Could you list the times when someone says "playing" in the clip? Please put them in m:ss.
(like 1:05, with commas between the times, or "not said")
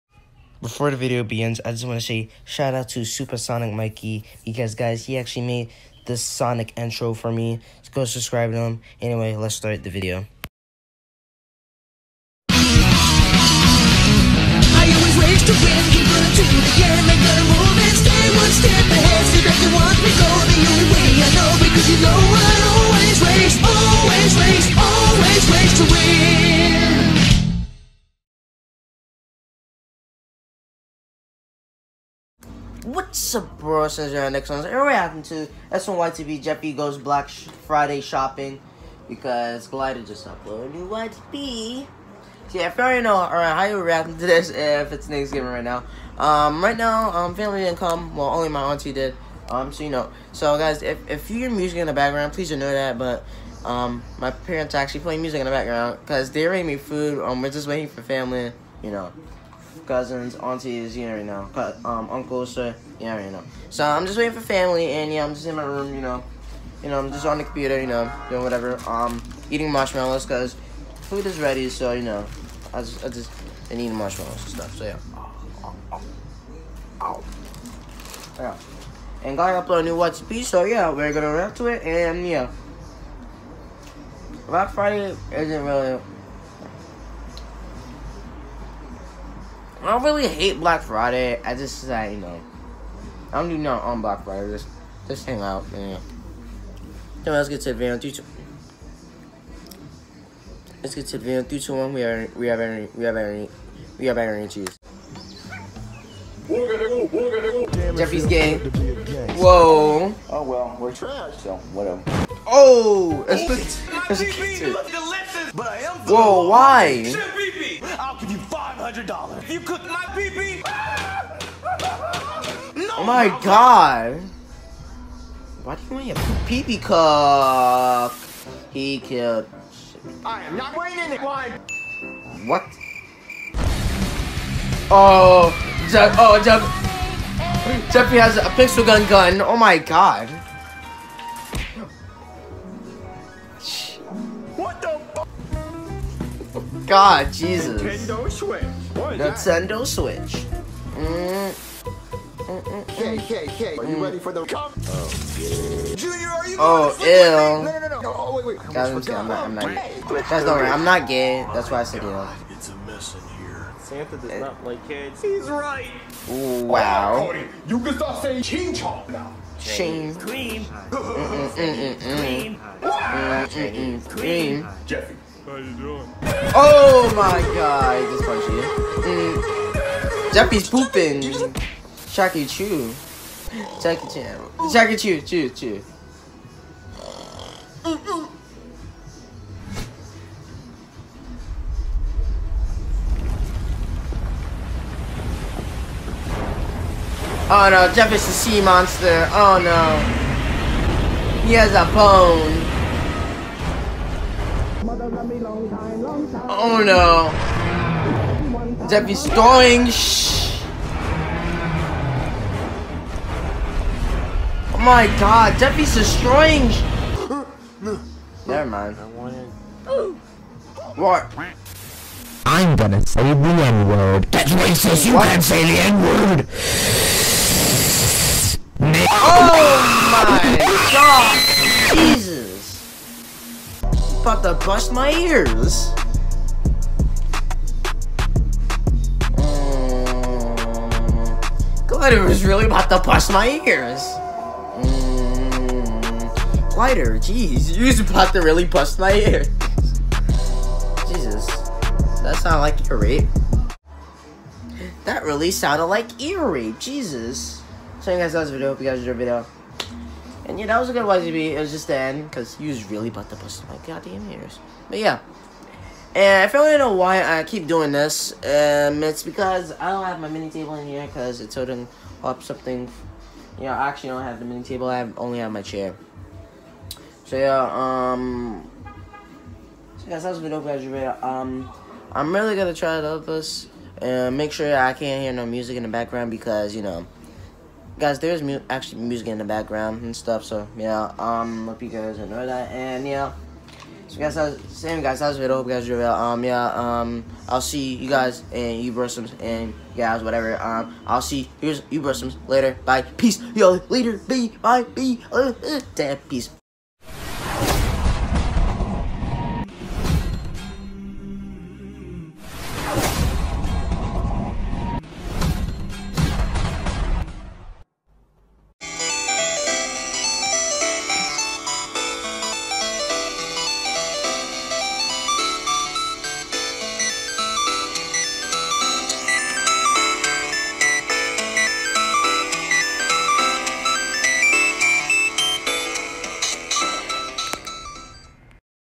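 0:55.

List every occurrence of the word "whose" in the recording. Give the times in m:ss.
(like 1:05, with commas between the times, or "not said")
not said.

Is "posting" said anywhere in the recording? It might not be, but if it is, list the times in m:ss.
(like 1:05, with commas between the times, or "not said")
not said.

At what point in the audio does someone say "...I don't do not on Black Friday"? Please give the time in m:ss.
1:33.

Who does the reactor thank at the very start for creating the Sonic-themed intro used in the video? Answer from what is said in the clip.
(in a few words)
Supersonic Mikey.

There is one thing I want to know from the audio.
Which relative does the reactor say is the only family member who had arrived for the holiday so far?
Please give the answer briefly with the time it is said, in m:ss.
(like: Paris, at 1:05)
auntie, at 0:48.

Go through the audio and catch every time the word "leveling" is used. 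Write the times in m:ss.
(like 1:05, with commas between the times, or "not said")
not said.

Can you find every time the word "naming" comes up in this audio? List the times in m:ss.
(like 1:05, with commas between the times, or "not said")
not said.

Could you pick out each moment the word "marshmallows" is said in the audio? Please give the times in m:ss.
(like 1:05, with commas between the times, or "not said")
1:09, 1:13.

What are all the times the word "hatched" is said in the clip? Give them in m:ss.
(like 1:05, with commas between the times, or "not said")
not said.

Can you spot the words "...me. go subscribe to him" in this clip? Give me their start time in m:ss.
0:07.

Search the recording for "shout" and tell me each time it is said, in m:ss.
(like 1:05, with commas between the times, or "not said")
0:02.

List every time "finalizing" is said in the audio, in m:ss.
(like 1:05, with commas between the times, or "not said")
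not said.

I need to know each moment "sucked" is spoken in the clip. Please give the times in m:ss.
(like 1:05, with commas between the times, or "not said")
not said.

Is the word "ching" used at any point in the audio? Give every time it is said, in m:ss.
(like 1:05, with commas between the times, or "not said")
2:48.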